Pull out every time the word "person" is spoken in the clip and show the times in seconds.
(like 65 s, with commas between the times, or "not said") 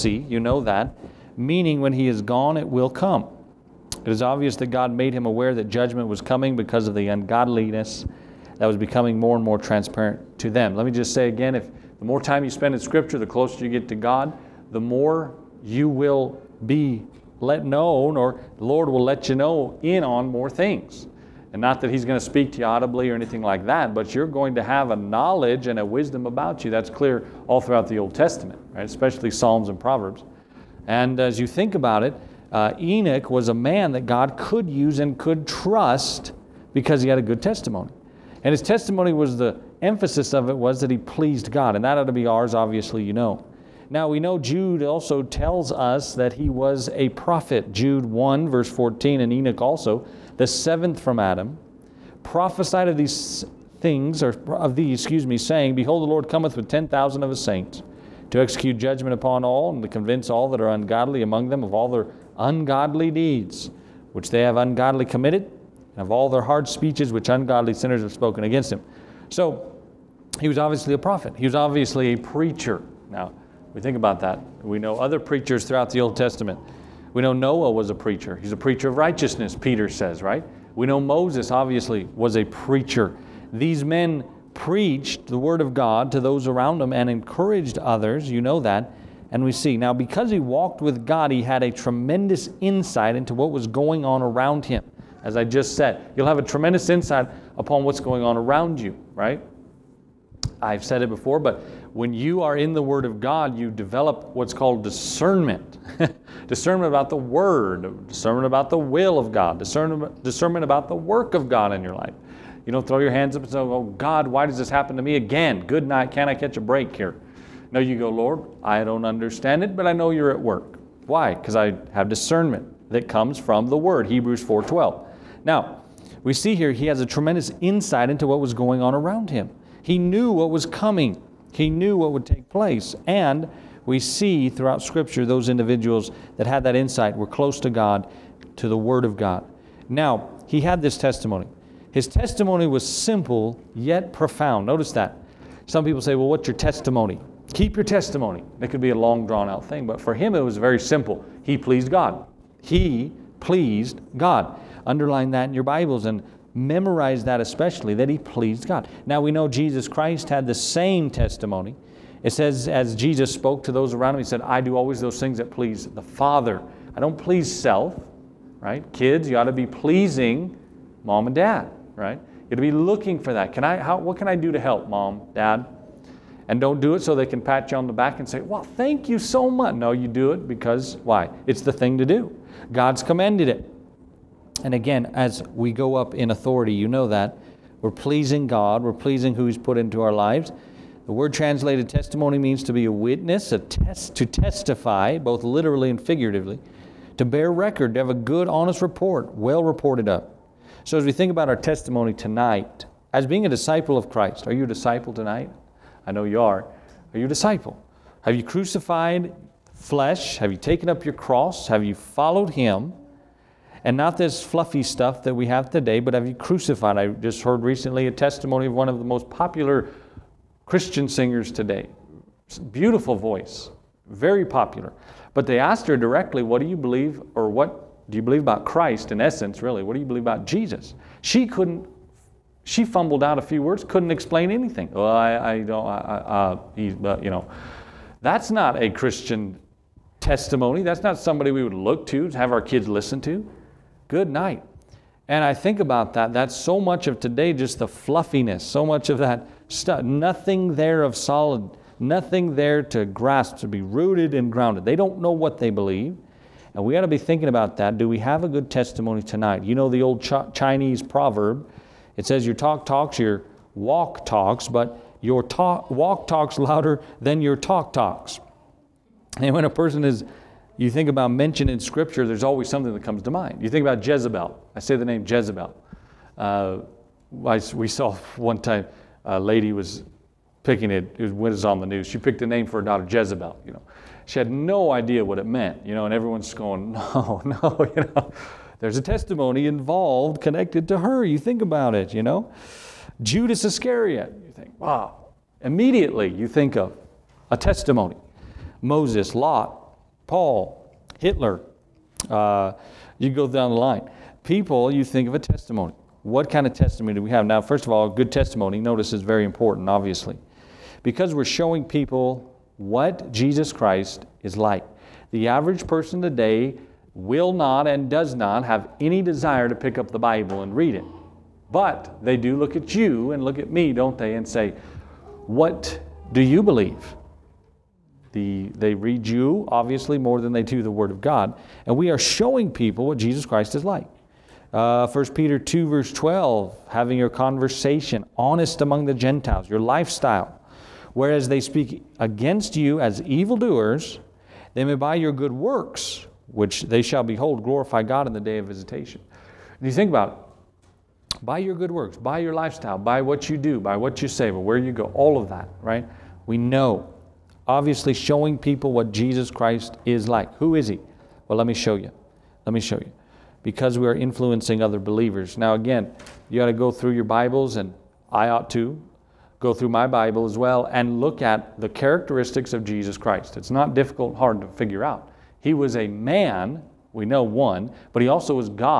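269 s, 315 s.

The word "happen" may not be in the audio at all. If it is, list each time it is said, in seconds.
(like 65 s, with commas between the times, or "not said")
114 s.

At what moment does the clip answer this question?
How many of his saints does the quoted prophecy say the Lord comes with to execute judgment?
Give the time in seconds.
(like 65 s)
56 s.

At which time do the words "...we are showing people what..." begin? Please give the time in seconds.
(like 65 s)
331 s.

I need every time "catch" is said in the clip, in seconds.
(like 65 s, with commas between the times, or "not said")
116 s.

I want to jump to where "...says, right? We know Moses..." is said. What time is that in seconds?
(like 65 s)
79 s.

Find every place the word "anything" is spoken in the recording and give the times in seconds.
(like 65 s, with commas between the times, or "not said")
23 s, 234 s.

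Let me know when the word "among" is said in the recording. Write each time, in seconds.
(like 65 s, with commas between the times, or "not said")
61 s, 338 s.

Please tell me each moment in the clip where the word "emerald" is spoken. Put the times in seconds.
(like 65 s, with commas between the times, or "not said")
not said.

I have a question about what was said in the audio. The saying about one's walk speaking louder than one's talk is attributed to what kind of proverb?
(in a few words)
Chinese proverb.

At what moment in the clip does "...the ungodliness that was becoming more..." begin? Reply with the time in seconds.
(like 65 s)
6 s.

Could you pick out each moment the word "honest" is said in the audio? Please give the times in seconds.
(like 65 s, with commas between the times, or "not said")
198 s, 338 s.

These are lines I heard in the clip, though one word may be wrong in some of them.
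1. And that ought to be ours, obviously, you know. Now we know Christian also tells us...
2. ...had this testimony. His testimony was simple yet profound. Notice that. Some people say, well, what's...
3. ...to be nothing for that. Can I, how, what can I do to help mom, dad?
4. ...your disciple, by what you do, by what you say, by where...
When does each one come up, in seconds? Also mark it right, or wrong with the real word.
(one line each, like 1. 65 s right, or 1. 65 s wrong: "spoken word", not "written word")
1. 41 s wrong: "Jude", not "Christian"
2. 140 s right
3. 172 s wrong: "looking", not "nothing"
4. 352 s wrong: "lifestyle", not "disciple".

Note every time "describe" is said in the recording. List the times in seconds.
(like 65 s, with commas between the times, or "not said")
not said.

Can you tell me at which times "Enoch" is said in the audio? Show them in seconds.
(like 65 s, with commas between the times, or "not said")
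32 s, 49 s.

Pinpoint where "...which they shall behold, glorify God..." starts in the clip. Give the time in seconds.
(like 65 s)
346 s.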